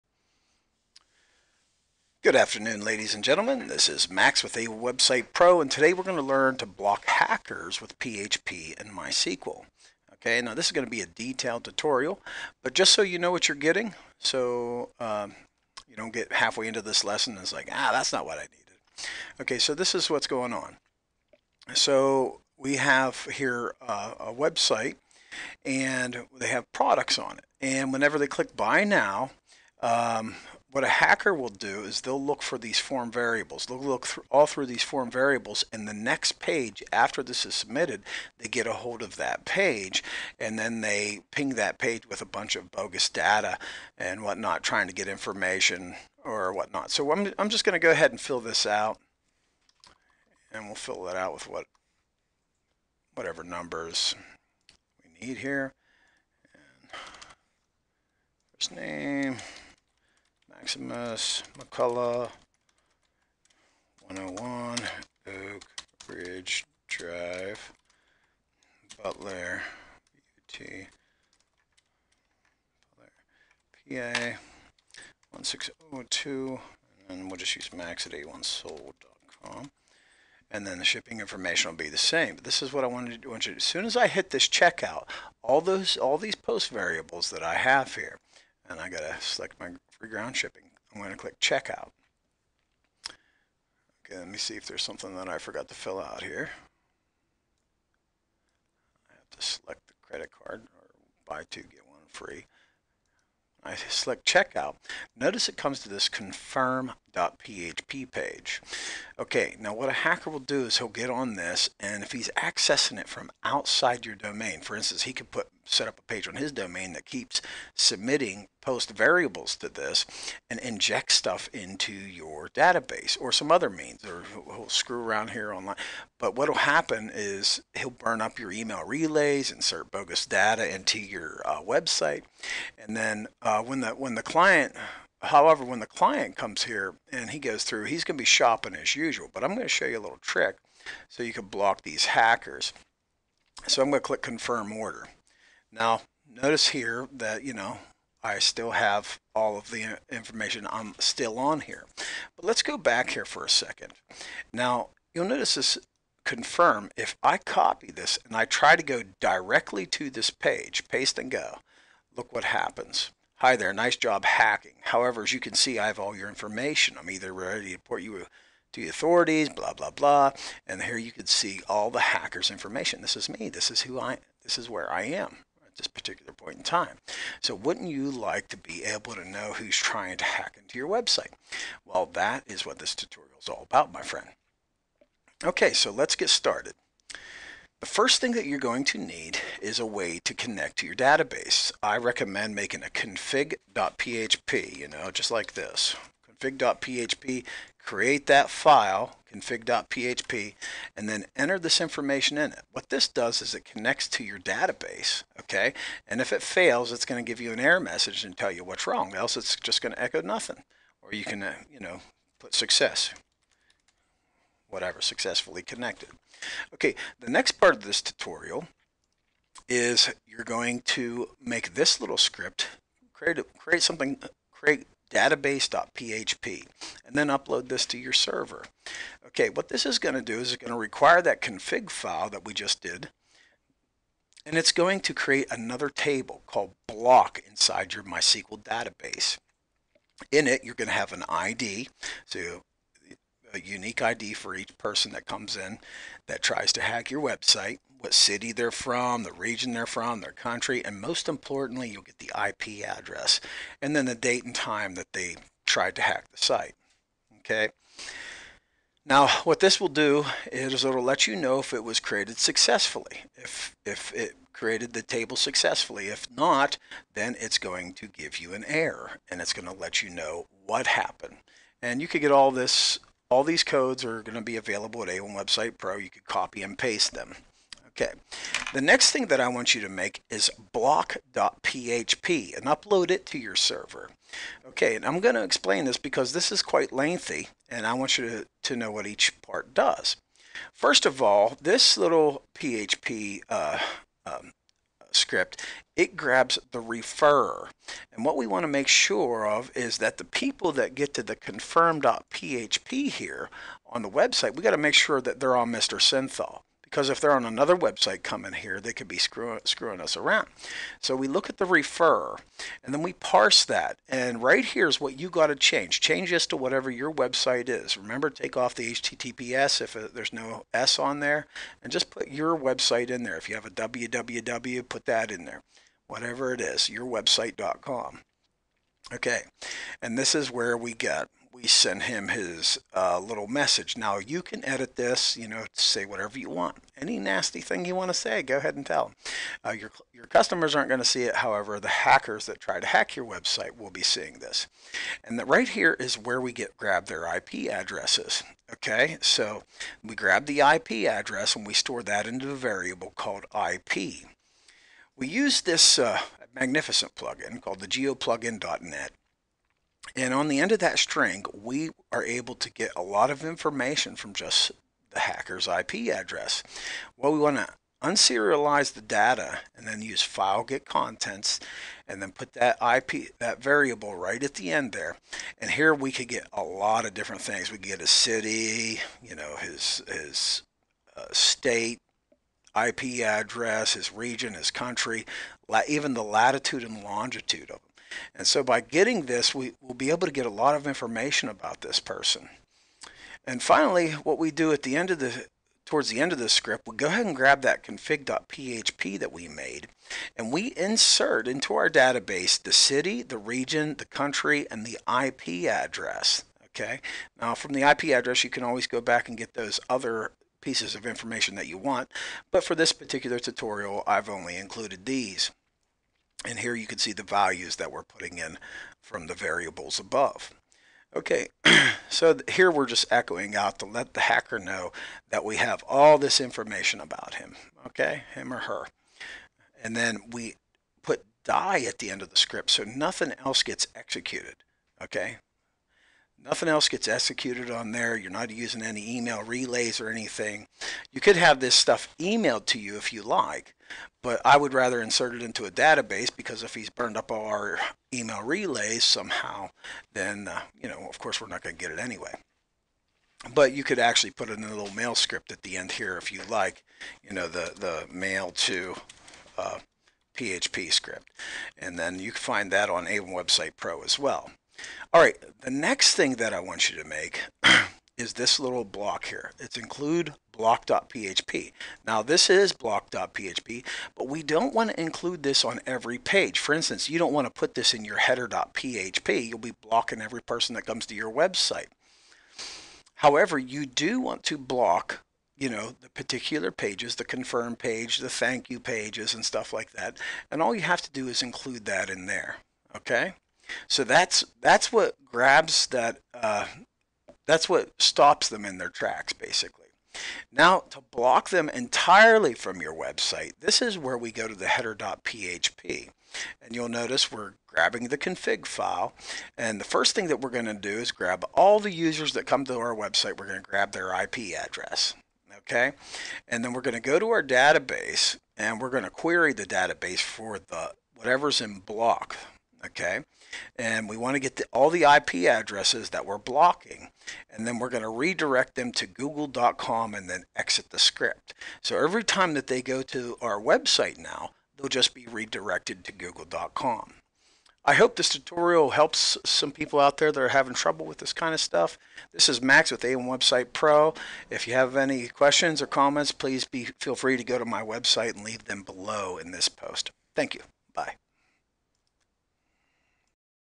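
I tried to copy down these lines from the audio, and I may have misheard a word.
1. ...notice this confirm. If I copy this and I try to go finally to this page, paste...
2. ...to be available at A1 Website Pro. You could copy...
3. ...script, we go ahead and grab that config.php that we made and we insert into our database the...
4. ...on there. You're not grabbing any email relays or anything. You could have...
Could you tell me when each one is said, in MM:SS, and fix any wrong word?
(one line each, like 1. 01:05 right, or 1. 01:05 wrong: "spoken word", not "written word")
1. 02:35 wrong: "directly", not "finally"
2. 04:34 right
3. 06:36 right
4. 07:17 wrong: "using", not "grabbing".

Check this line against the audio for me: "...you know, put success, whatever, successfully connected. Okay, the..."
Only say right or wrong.
right.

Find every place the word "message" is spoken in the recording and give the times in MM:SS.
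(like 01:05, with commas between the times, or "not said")
03:27, 05:33.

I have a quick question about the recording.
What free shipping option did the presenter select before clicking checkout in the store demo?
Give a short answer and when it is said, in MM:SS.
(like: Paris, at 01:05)
free ground shipping, at 01:29.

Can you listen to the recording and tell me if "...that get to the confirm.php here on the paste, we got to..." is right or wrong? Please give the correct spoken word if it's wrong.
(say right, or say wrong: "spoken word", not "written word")
wrong: "website", not "paste".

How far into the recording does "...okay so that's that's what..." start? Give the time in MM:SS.
08:12.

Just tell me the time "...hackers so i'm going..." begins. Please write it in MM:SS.
02:22.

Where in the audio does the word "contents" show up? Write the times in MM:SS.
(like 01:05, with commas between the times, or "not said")
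06:10.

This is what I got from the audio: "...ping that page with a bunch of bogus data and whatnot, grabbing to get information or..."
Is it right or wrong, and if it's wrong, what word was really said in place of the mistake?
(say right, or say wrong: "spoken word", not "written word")
wrong: "trying", not "grabbing".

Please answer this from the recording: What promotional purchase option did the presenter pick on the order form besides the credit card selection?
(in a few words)
buy two, get one free.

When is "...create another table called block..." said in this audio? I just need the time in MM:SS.
03:55.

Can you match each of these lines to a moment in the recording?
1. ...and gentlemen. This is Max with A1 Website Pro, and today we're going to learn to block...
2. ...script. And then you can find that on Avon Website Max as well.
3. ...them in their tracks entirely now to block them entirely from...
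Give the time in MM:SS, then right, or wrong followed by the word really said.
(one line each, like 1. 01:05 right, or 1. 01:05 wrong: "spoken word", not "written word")
1. 00:03 right
2. 07:40 wrong: "Pro", not "Max"
3. 08:18 wrong: "basically", not "entirely".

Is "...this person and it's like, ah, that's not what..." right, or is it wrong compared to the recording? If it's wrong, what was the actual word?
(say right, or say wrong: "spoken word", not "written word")
wrong: "lesson", not "person".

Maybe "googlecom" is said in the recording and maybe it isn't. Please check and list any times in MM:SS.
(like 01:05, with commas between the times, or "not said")
08:49, 08:56.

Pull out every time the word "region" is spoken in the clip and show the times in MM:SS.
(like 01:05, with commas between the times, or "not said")
04:09, 06:24, 06:43.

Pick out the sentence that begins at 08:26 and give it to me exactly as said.
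And you'll notice we're grabbing the config file.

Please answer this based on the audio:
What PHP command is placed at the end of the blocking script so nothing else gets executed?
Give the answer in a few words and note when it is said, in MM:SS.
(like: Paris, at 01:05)
die, at 07:11.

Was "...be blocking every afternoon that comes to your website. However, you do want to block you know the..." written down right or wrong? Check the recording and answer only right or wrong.
wrong.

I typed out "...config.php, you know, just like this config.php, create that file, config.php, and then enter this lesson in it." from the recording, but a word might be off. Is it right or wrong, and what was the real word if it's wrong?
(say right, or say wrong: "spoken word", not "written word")
wrong: "information", not "lesson".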